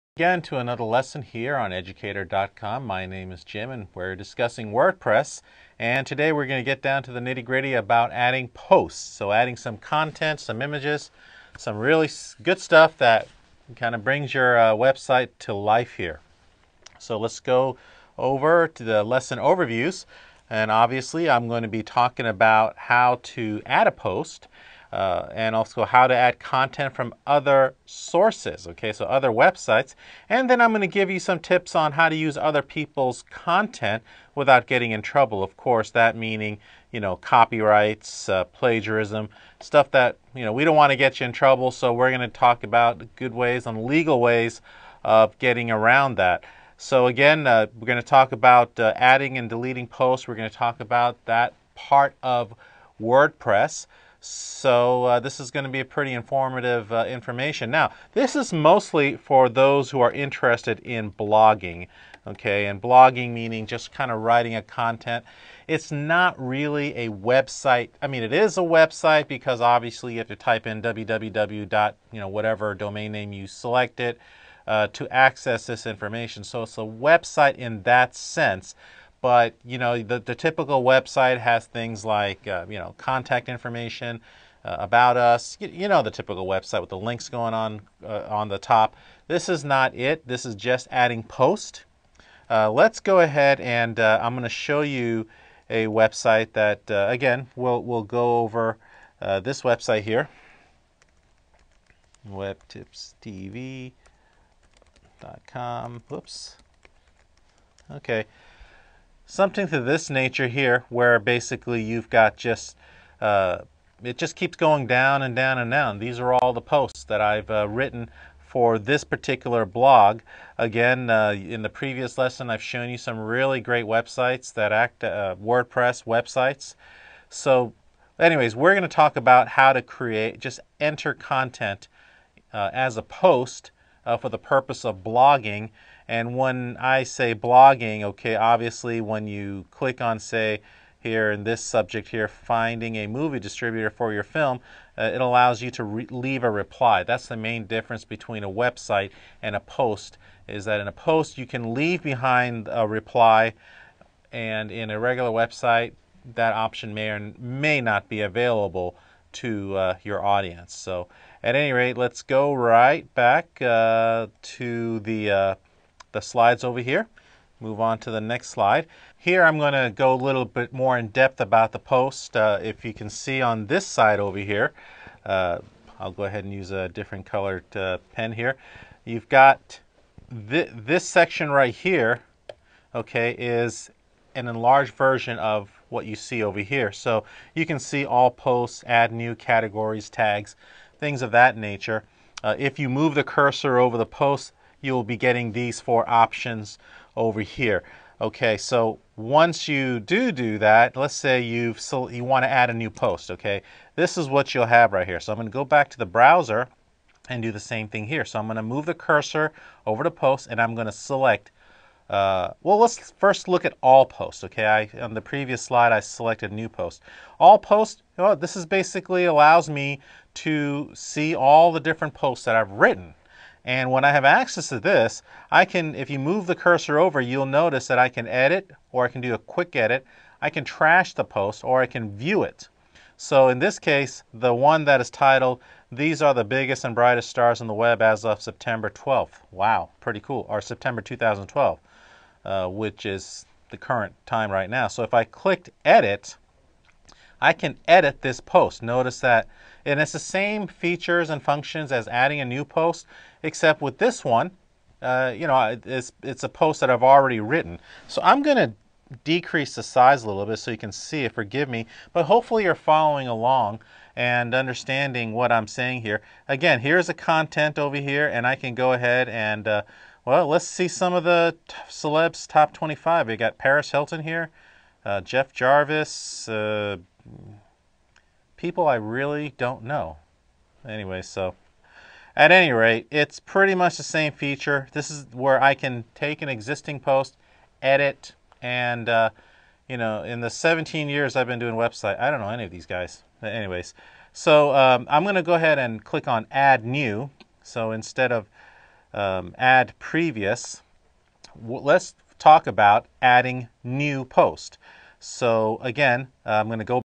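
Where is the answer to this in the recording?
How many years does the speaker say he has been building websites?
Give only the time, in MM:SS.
04:50.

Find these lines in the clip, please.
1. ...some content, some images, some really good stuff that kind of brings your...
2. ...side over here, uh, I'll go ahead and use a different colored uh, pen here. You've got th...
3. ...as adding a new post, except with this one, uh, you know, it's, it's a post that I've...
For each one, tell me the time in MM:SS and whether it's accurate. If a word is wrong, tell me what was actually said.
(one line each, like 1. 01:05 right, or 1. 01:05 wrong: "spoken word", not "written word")
1. 00:09 right
2. 02:53 right
3. 04:11 right.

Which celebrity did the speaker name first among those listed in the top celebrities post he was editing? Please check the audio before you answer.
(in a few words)
Paris Hilton.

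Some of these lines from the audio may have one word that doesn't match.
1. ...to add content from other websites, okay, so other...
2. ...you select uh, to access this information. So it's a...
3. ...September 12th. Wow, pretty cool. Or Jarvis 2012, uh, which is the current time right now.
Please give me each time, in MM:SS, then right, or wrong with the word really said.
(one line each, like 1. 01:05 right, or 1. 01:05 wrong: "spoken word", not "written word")
1. 00:26 wrong: "sources", not "websites"
2. 01:13 right
3. 03:58 wrong: "September", not "Jarvis".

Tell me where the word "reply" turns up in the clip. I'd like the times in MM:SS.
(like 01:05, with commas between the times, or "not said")
02:26, 02:32.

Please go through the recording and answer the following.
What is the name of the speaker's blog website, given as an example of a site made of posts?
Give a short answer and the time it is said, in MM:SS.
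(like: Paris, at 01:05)
webtipstv.com, at 01:42.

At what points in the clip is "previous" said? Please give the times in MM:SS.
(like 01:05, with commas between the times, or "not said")
02:01, 03:35, 04:59.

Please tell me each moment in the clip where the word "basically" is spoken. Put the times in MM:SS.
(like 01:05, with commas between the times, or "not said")
01:51, 03:38.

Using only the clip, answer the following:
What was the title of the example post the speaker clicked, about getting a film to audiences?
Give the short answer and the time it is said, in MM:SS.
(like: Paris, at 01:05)
Finding a movie distributor for your film, at 02:22.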